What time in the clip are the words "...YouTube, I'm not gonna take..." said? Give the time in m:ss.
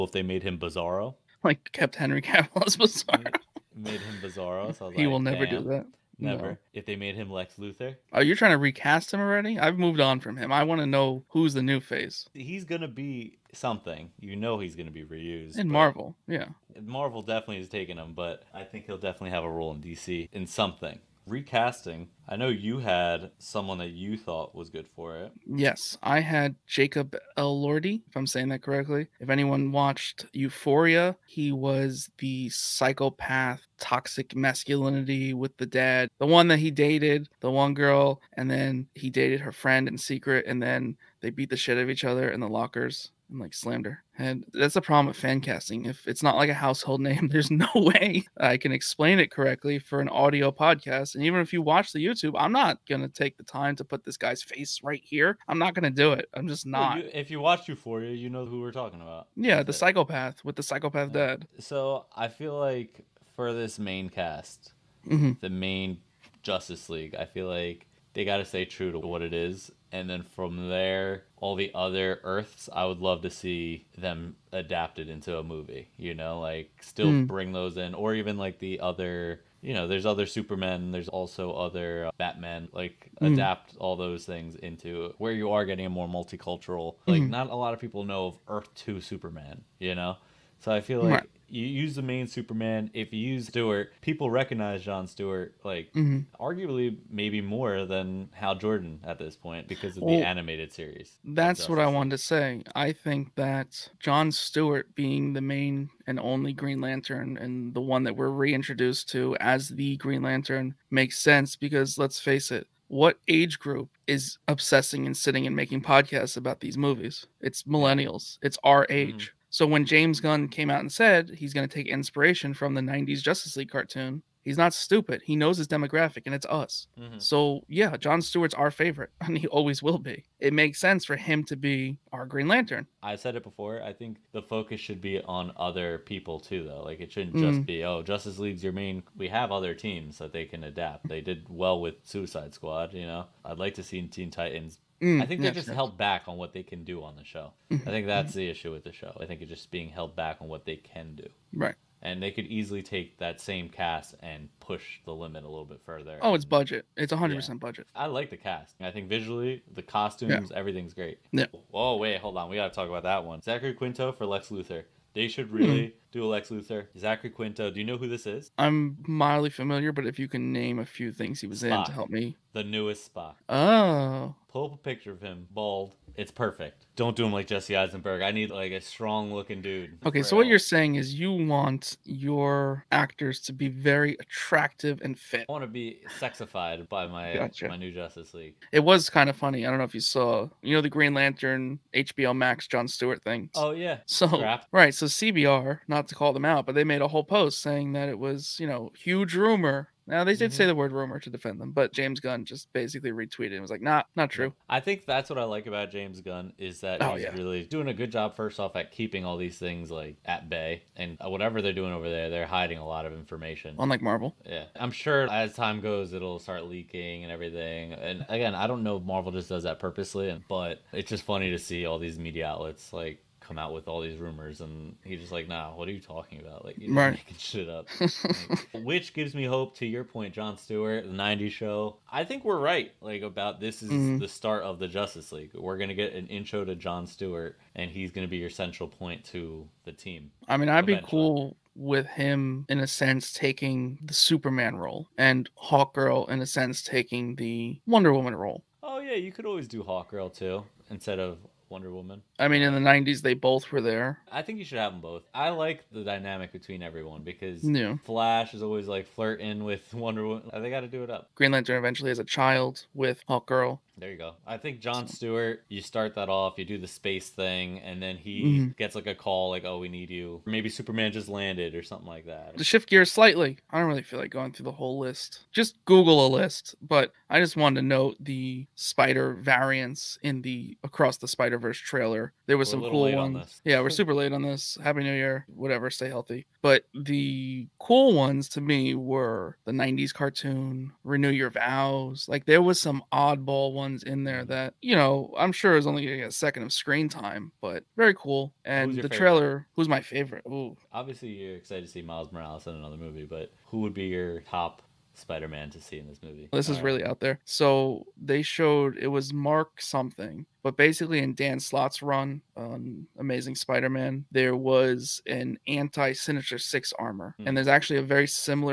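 0:52.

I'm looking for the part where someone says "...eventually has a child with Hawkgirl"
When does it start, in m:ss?
4:21.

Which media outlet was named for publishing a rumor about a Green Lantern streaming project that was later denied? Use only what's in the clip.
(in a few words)
CBR.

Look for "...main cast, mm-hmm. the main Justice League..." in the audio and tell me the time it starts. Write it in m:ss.
1:03.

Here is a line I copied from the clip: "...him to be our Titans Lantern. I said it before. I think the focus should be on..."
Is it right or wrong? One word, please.
wrong.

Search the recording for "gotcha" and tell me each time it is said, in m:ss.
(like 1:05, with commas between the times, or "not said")
3:07.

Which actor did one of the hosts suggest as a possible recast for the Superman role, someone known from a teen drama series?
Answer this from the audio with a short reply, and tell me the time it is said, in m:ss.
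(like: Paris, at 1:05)
Jacob Elordi, at 0:26.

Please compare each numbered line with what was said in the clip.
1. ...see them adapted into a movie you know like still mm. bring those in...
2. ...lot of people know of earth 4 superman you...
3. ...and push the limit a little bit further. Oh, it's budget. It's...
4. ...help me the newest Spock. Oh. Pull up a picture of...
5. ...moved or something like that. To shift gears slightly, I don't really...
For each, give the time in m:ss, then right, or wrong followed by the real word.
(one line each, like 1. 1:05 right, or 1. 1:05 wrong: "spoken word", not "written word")
1. 1:13 right
2. 1:27 wrong: "2", not "4"
3. 2:34 right
4. 2:51 right
5. 4:31 wrong: "landed", not "moved".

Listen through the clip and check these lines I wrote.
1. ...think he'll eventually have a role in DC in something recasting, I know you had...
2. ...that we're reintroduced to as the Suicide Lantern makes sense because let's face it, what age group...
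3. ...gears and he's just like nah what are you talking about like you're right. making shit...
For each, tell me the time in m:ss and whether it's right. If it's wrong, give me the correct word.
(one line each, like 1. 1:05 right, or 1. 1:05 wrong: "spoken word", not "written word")
1. 0:18 wrong: "definitely", not "eventually"
2. 1:48 wrong: "Green", not "Suicide"
3. 3:44 wrong: "rumors", not "gears".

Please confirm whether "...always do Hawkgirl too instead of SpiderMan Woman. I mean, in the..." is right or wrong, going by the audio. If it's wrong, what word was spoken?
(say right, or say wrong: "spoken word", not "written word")
wrong: "Wonder", not "SpiderMan".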